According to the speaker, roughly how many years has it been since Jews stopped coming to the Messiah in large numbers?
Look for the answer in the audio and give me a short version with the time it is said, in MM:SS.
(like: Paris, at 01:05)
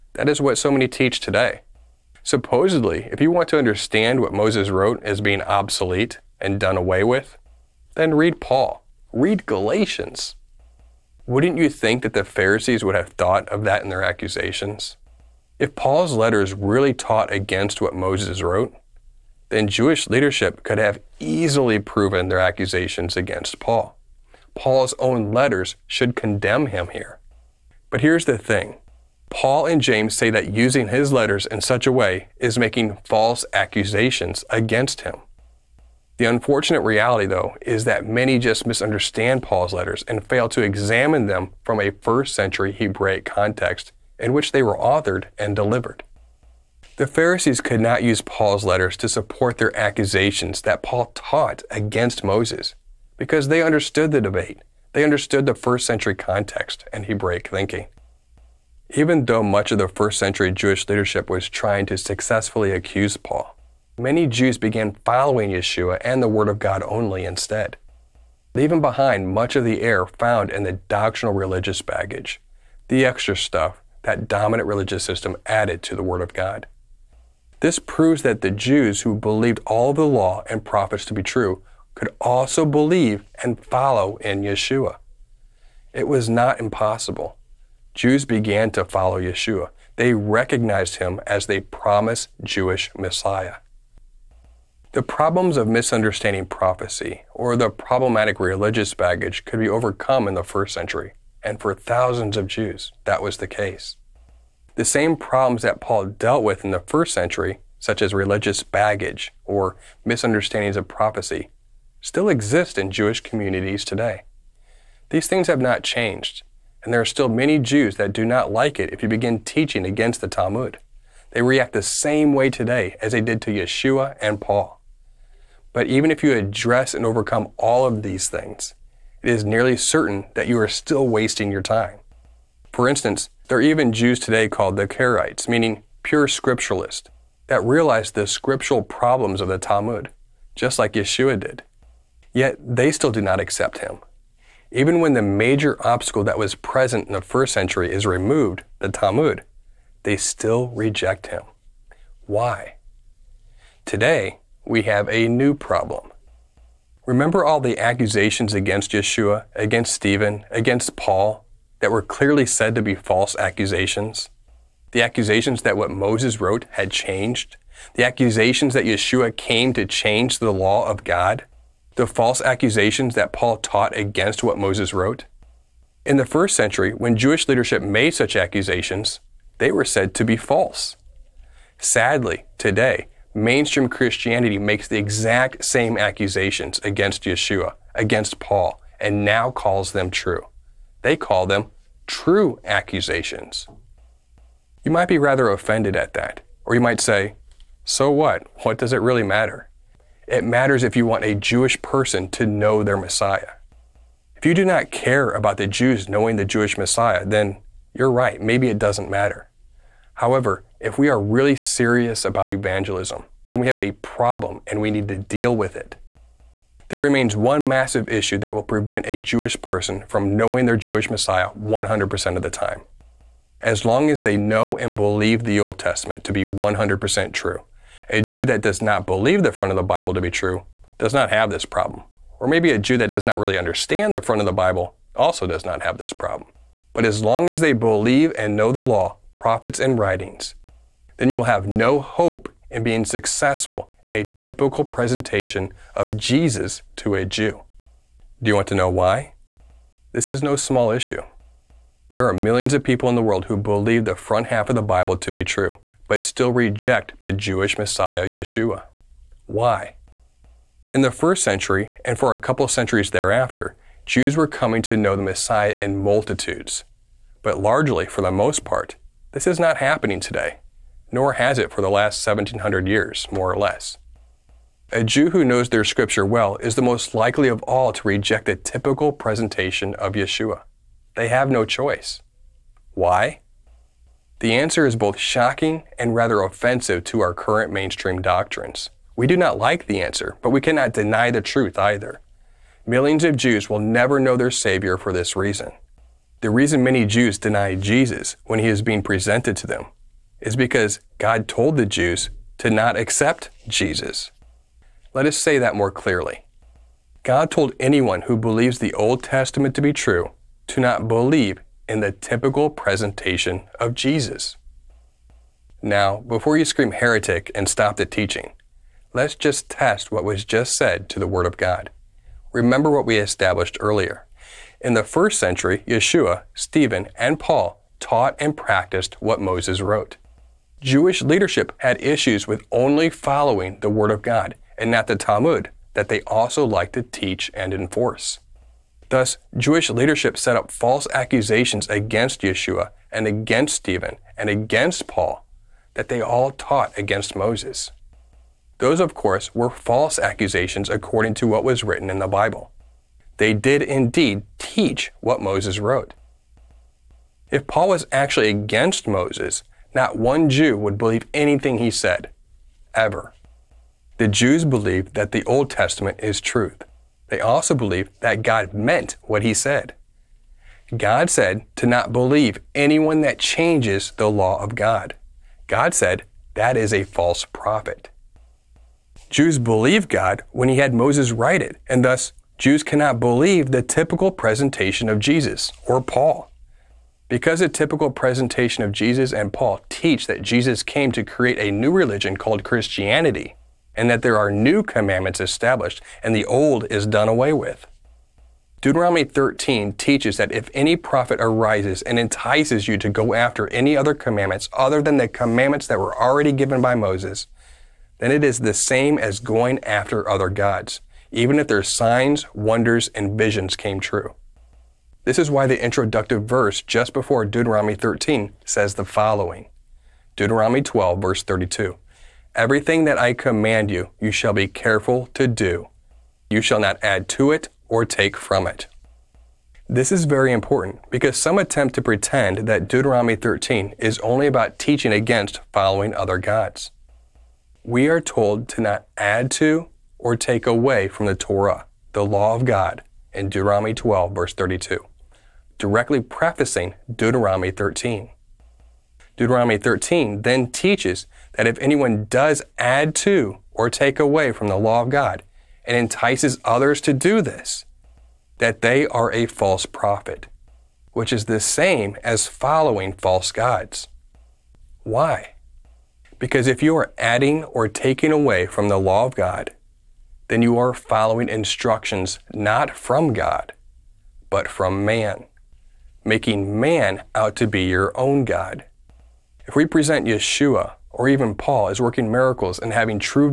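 1700 years, at 04:32.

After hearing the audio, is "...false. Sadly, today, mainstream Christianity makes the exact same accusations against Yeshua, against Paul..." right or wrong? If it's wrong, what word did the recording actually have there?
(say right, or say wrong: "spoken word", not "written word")
right.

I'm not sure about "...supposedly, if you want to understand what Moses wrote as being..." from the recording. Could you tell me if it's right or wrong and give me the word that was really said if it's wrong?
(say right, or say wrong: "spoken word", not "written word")
right.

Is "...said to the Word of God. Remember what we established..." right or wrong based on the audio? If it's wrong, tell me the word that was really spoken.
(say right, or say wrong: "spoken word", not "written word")
right.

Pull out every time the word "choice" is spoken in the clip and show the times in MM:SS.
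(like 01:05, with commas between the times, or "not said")
04:41.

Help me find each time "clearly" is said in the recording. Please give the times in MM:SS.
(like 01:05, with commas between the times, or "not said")
02:42, 05:05.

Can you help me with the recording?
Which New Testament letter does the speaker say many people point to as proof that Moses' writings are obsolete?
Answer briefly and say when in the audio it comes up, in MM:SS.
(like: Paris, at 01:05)
Galatians, at 00:09.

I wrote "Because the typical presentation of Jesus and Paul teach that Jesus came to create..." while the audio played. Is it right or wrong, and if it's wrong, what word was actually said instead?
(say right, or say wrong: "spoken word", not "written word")
right.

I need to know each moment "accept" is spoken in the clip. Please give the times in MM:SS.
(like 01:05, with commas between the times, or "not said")
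02:23, 05:02.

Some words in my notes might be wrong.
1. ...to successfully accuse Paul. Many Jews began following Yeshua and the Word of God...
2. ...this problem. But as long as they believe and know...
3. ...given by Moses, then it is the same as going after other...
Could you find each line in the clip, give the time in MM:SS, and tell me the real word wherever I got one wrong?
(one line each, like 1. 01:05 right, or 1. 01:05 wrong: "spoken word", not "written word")
1. 01:01 right
2. 03:55 right
3. 06:46 right.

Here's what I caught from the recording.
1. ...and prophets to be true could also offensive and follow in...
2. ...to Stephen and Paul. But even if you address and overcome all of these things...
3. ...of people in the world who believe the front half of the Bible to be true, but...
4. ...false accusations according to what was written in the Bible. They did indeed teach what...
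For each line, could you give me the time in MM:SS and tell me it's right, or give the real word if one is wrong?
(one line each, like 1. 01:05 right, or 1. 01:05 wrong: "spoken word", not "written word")
1. 01:20 wrong: "believe", not "offensive"
2. 02:03 wrong: "Yeshua", not "Stephen"
3. 04:12 right
4. 05:49 right.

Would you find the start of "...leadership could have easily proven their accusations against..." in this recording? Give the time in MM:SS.
00:20.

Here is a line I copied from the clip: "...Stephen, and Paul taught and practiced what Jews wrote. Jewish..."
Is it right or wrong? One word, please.
wrong.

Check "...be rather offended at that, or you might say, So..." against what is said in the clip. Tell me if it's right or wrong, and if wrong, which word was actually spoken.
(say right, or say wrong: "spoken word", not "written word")
right.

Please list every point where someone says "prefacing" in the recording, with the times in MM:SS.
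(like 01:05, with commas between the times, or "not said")
07:26.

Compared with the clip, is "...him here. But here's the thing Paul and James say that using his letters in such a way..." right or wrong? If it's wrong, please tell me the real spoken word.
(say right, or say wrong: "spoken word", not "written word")
right.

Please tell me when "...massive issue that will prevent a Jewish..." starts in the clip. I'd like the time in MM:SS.
03:37.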